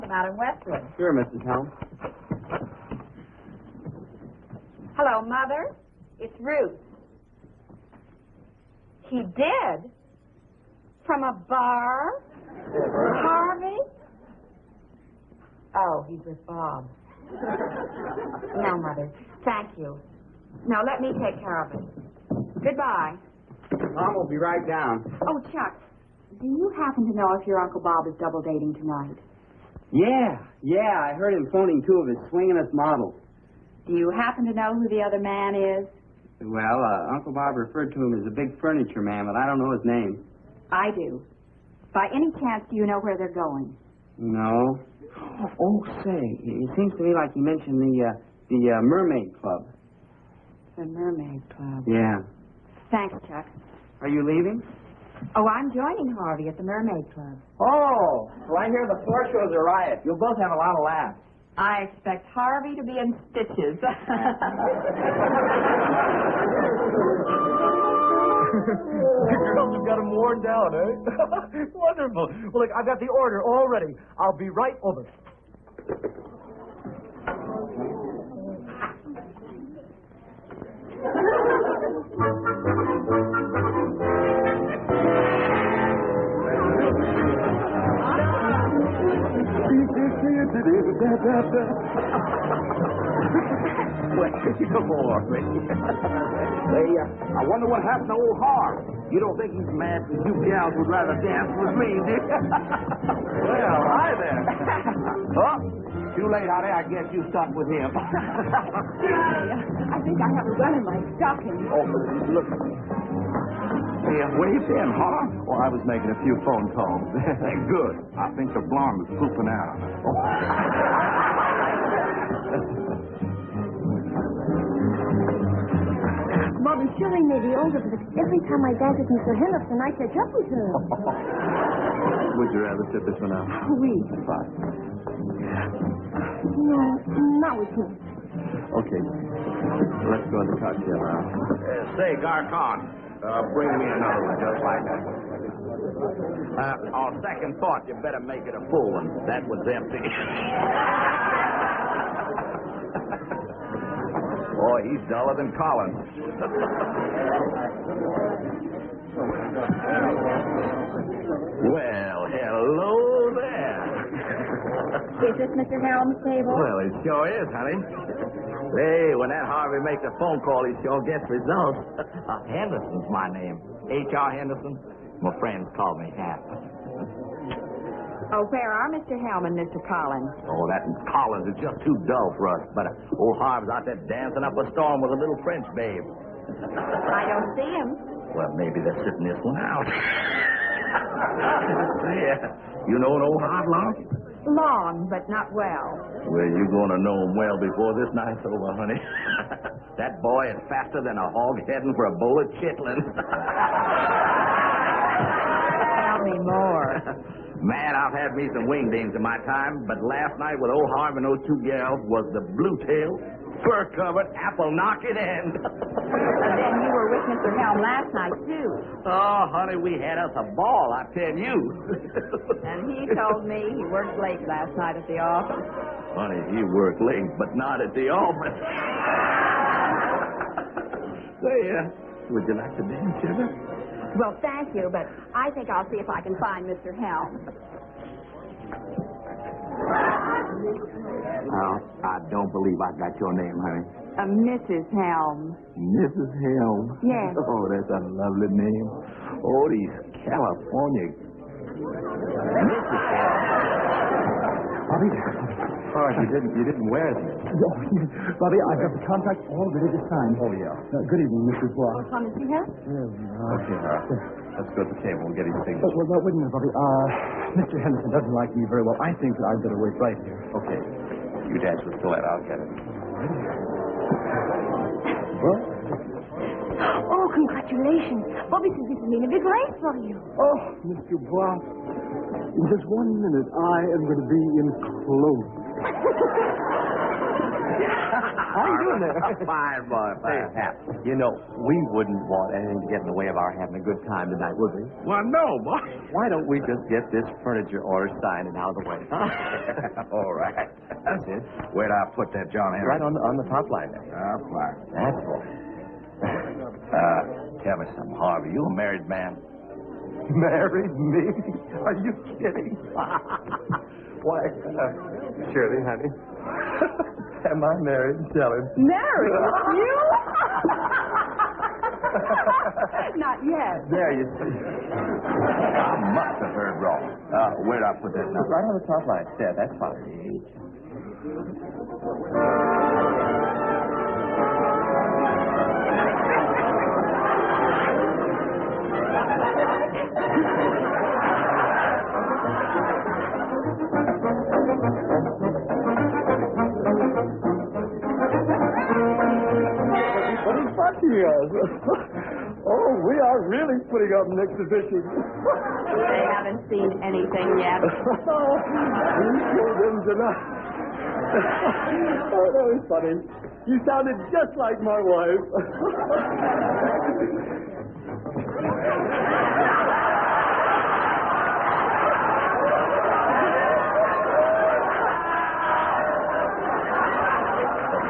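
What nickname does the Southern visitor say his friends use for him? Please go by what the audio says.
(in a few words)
Hap.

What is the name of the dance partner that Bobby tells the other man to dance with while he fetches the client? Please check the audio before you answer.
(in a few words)
Colette.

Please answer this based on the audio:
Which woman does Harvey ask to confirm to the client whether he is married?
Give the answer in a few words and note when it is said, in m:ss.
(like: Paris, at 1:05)
Shirley, at 5:15.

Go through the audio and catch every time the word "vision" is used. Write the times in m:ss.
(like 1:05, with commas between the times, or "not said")
not said.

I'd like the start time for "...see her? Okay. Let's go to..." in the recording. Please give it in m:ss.
4:22.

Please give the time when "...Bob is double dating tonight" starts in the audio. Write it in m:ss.
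0:27.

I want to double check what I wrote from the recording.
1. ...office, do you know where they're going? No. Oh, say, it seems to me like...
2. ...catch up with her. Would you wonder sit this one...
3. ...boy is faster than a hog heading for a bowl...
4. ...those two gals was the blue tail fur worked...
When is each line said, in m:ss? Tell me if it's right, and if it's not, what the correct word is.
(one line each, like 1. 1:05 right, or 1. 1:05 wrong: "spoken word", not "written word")
1. 0:42 wrong: "chance", not "office"
2. 2:09 wrong: "rather", not "wonder"
3. 3:20 right
4. 3:31 wrong: "covered", not "worked".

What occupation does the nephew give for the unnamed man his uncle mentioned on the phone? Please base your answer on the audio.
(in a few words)
big furniture man.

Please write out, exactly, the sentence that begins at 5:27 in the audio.
Uh, where would I put that number?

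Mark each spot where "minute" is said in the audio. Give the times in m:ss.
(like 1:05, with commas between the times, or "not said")
4:26, 4:43.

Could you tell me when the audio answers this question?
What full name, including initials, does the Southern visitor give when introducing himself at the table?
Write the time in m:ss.
2:53.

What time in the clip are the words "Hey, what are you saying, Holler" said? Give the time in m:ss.
1:54.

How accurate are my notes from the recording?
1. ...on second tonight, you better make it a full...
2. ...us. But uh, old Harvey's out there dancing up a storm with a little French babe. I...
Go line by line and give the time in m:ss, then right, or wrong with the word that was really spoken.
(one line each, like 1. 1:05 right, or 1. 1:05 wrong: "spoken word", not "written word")
1. 2:26 wrong: "thought", not "tonight"
2. 3:02 right.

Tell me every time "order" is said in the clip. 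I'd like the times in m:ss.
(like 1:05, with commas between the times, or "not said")
1:13, 4:57.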